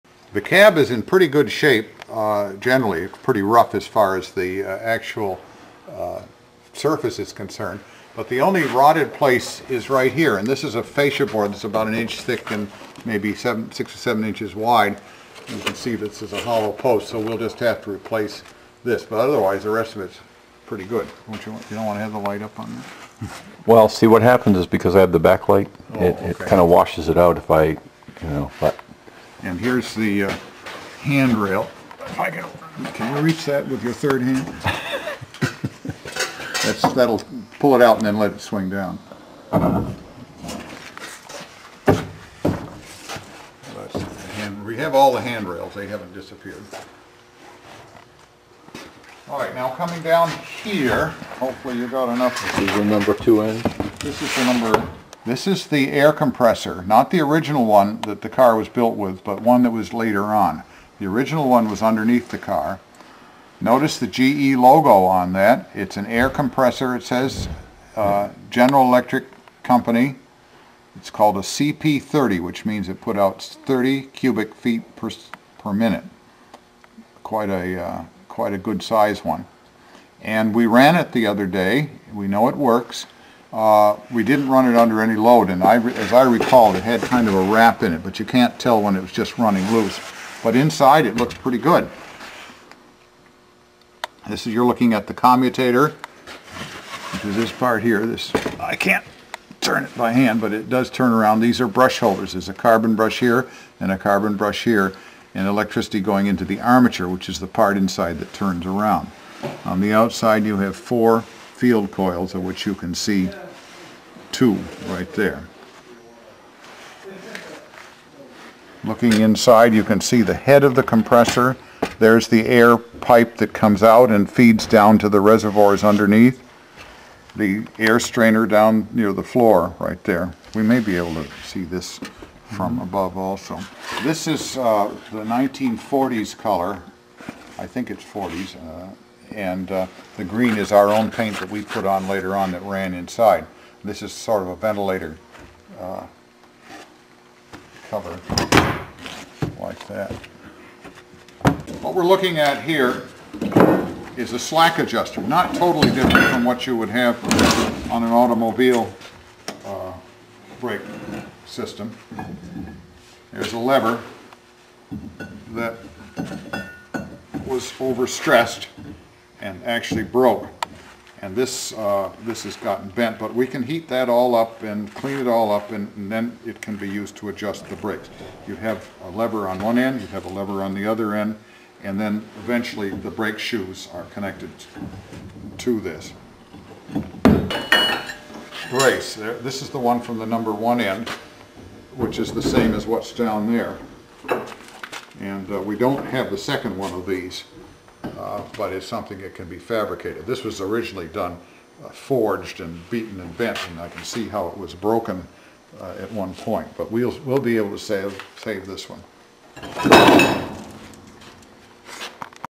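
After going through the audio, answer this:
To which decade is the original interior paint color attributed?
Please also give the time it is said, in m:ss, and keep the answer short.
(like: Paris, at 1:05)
1940s, at 2:15.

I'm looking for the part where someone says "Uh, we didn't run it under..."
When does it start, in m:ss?
1:23.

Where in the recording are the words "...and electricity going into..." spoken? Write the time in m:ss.
1:45.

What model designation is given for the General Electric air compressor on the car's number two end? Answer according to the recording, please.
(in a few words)
CP30.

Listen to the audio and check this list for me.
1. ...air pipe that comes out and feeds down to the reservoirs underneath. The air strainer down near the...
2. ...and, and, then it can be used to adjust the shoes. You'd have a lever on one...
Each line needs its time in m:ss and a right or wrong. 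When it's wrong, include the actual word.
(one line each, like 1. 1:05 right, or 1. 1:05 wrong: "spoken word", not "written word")
1. 2:02 right
2. 2:55 wrong: "brakes", not "shoes".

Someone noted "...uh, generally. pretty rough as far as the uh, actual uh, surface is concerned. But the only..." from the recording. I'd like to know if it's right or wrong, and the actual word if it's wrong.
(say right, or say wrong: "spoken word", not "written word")
right.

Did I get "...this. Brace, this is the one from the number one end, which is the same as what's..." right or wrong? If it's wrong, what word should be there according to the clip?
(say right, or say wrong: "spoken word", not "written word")
right.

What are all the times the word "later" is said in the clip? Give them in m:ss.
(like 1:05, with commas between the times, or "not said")
0:59, 2:22.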